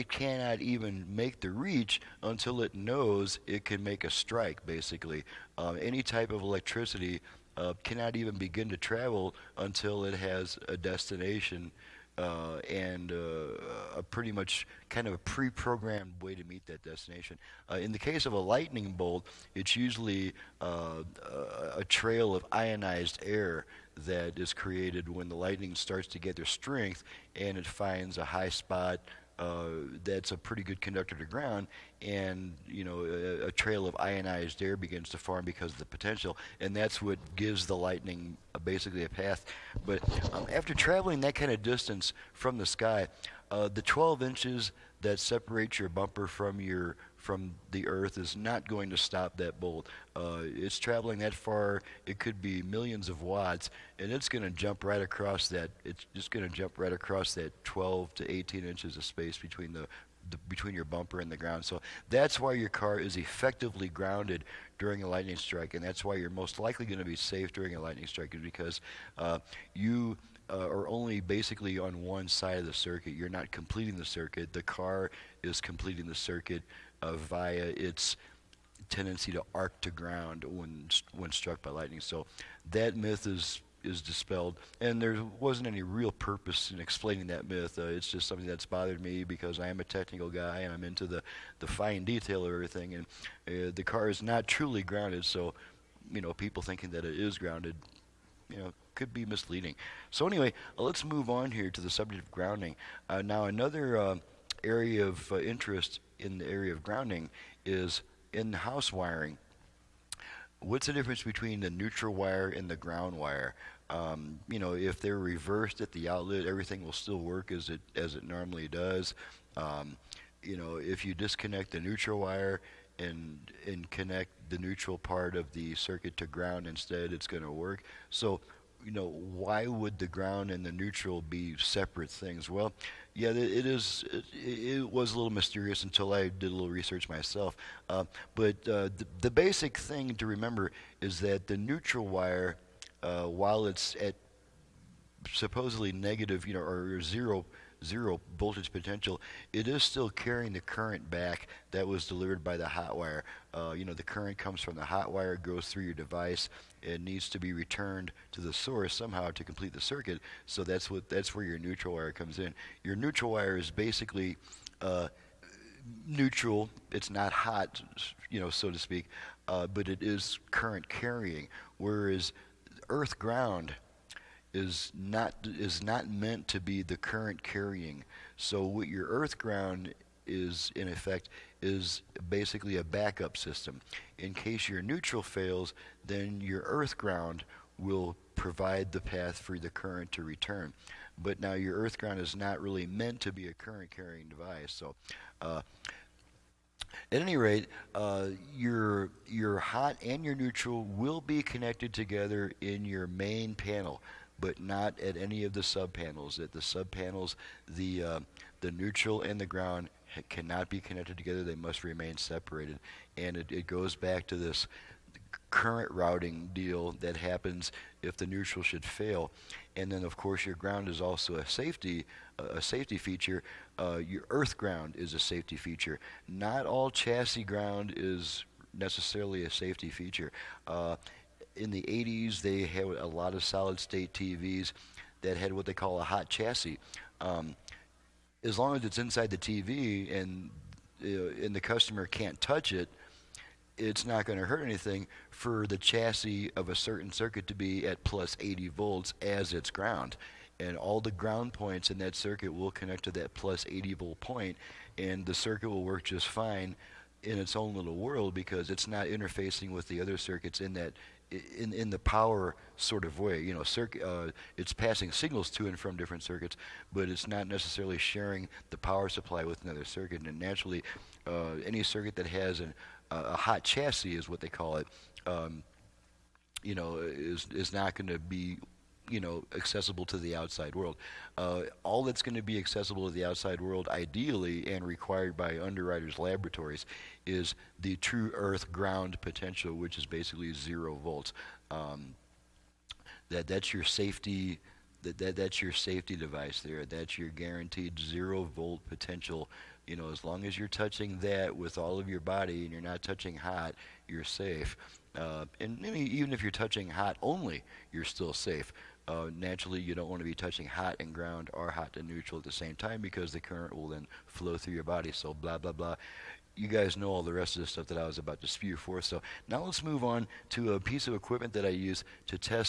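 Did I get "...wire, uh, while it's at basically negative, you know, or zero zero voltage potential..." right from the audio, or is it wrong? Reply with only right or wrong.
wrong.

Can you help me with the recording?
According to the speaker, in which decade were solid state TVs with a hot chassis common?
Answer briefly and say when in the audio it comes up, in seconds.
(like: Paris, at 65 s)
the 80s, at 231 s.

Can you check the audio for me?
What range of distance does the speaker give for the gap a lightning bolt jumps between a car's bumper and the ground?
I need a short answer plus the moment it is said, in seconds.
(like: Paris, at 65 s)
12 to 18 inches, at 57 s.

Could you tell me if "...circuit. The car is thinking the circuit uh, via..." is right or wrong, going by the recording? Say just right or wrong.
wrong.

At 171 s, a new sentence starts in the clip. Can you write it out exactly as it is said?
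Whereas earth ground is not is not meant to be the current carrying.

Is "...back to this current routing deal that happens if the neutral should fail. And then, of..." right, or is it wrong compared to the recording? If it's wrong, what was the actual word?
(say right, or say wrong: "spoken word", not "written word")
right.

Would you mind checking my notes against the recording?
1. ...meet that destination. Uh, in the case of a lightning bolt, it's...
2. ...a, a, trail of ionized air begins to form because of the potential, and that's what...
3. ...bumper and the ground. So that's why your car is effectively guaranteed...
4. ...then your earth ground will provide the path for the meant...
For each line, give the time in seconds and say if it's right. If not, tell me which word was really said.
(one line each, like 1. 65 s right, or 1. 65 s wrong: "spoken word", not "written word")
1. 16 s right
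2. 33 s right
3. 60 s wrong: "grounded", not "guaranteed"
4. 186 s wrong: "current", not "meant".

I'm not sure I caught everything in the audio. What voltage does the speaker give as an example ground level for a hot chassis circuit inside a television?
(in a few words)
plus 80 volts.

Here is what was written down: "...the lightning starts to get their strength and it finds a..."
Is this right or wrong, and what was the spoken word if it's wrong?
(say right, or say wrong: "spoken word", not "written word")
right.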